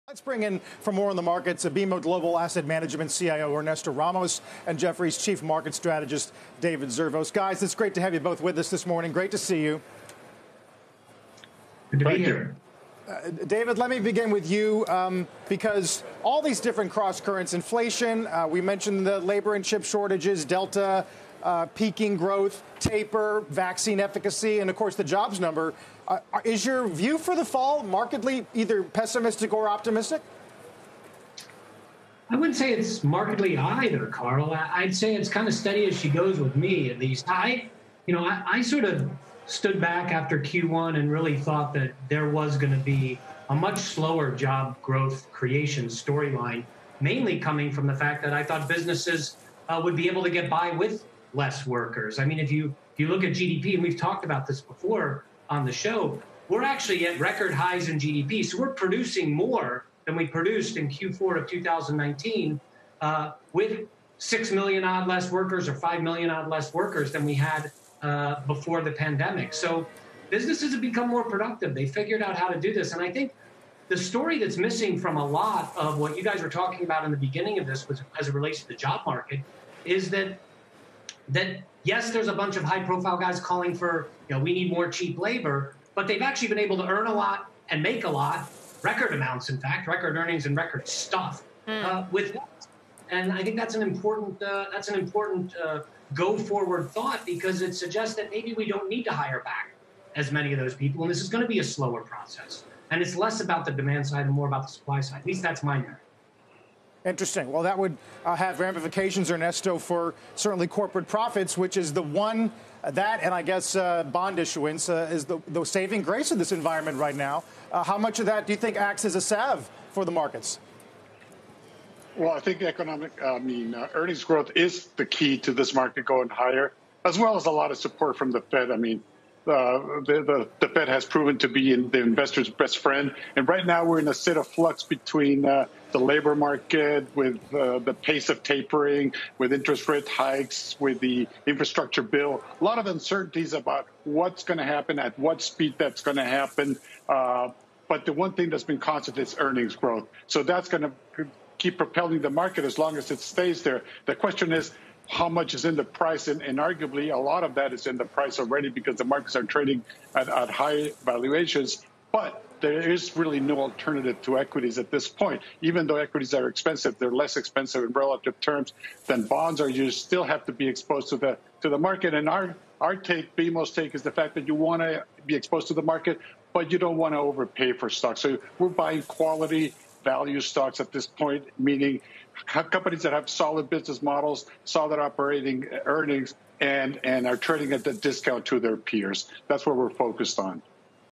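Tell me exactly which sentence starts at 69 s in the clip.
So businesses have become more productive.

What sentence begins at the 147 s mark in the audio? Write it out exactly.
Uh, but the one thing that's been constant is earnings growth.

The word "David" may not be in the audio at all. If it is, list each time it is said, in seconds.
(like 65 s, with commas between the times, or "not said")
6 s, 13 s.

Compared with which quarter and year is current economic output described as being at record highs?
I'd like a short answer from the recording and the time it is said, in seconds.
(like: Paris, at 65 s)
Q4 of 2019, at 60 s.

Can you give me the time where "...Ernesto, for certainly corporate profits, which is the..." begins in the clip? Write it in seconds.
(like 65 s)
109 s.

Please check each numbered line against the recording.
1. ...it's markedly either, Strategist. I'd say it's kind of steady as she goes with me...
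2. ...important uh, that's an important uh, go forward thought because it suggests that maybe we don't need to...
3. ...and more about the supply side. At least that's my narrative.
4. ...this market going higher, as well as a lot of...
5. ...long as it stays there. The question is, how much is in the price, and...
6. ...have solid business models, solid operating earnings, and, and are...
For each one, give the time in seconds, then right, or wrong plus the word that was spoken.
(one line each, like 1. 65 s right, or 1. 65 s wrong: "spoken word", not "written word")
1. 32 s wrong: "Carl", not "Strategist"
2. 93 s right
3. 104 s right
4. 125 s right
5. 152 s right
6. 183 s right.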